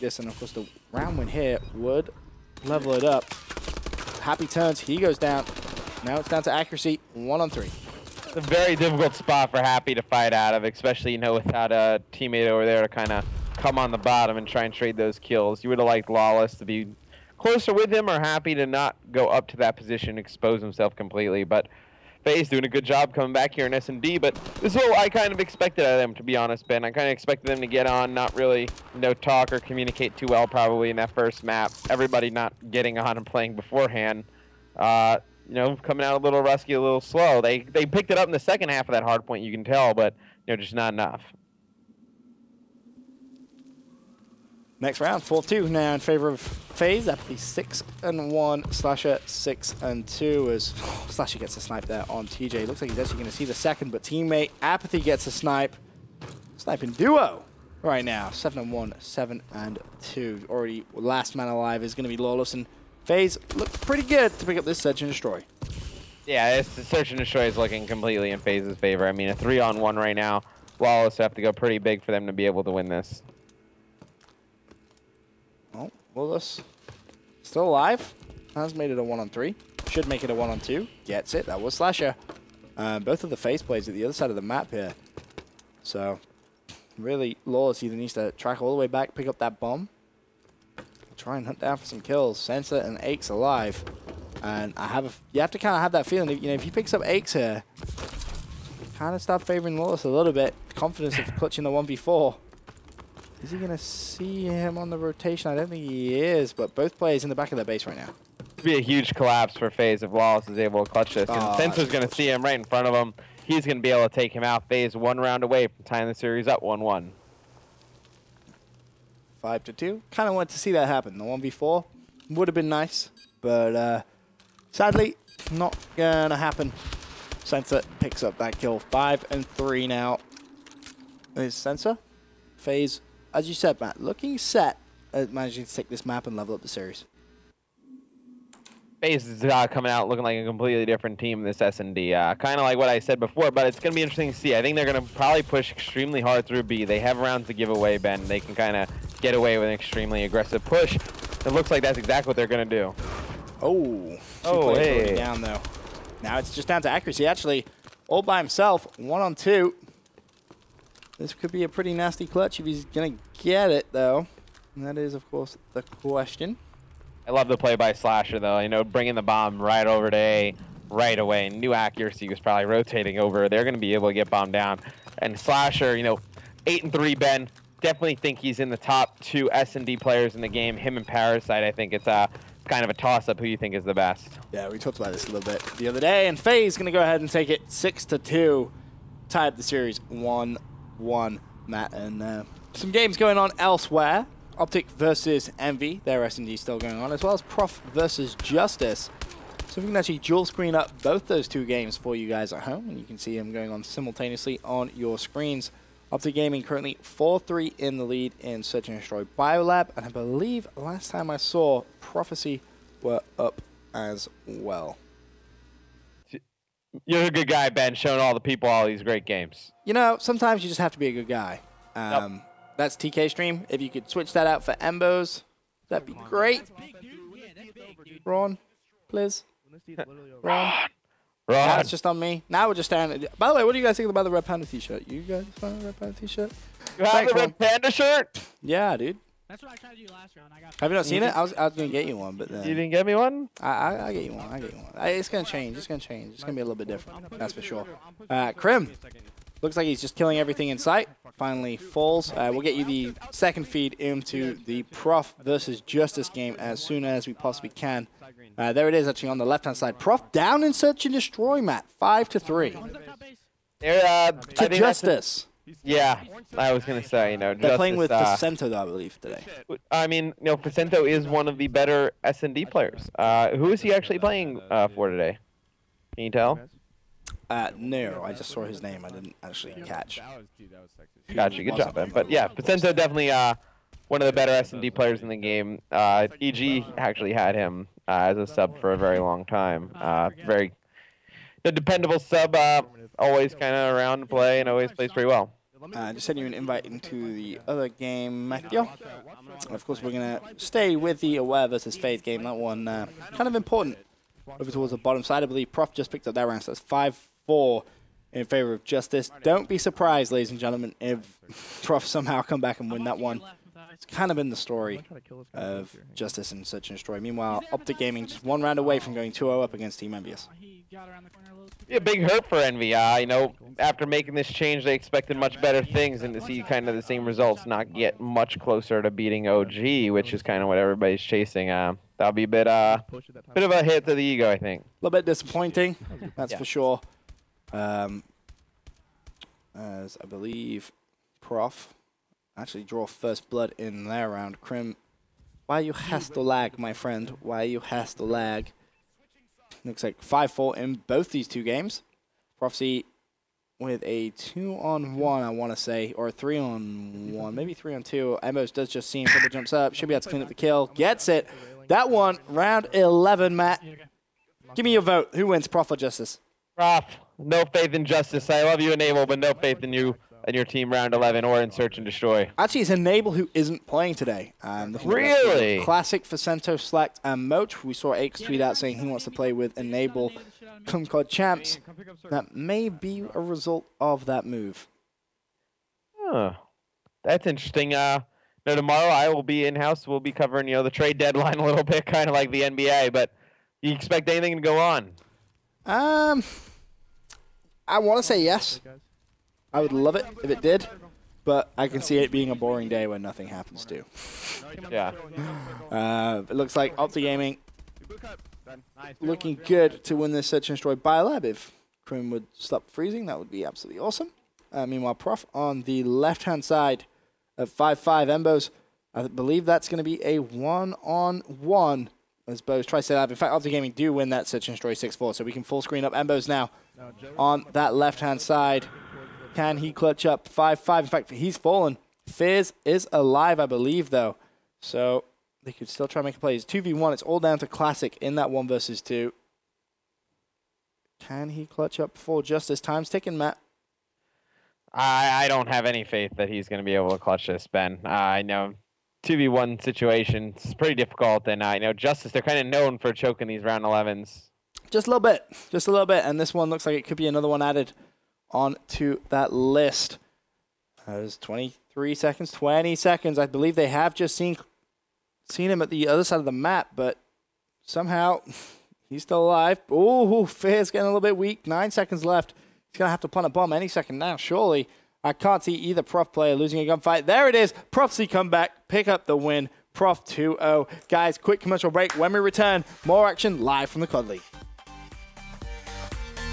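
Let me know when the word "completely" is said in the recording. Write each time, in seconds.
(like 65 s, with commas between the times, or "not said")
20 s, 67 s, 140 s.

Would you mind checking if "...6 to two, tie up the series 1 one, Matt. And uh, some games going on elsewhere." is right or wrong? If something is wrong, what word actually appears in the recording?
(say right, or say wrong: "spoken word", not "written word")
right.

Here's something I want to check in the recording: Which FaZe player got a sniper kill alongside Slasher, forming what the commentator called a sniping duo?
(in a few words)
Apathy.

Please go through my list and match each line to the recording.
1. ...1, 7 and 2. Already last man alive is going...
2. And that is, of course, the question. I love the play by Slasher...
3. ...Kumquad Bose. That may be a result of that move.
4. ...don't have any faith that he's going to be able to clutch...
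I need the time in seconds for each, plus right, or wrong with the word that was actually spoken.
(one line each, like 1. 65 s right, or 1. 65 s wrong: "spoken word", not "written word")
1. 58 s right
2. 164 s right
3. 380 s wrong: "Champs", not "Bose"
4. 445 s right.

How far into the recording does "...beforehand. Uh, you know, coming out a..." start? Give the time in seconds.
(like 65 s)
33 s.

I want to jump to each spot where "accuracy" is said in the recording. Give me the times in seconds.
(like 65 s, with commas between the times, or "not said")
6 s, 156 s, 171 s.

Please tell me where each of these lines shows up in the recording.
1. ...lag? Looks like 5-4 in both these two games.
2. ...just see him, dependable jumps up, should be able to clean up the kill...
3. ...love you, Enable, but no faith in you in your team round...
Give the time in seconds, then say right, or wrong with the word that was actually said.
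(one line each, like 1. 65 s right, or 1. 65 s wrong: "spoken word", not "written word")
1. 348 s right
2. 358 s wrong: "double", not "dependable"
3. 368 s right.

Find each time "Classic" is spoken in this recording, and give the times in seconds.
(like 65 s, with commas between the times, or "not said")
375 s, 437 s.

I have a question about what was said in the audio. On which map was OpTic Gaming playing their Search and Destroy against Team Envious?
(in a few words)
Biolab.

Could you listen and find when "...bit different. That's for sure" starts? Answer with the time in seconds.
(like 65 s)
246 s.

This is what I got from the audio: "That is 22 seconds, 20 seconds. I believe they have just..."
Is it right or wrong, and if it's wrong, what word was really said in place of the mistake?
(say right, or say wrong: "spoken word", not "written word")
wrong: "23", not "22".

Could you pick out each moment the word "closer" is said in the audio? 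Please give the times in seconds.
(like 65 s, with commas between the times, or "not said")
17 s, 328 s.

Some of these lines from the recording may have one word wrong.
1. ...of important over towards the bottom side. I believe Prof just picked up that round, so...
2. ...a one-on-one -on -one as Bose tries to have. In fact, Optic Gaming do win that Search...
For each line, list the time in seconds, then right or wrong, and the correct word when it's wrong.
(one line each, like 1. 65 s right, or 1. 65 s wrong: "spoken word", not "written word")
1. 303 s right
2. 420 s right.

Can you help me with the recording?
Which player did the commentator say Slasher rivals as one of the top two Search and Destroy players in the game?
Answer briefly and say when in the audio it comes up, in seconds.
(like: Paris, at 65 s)
Parasite, at 181 s.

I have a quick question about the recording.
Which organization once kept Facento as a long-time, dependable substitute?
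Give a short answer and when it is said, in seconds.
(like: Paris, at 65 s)
EG, at 286 s.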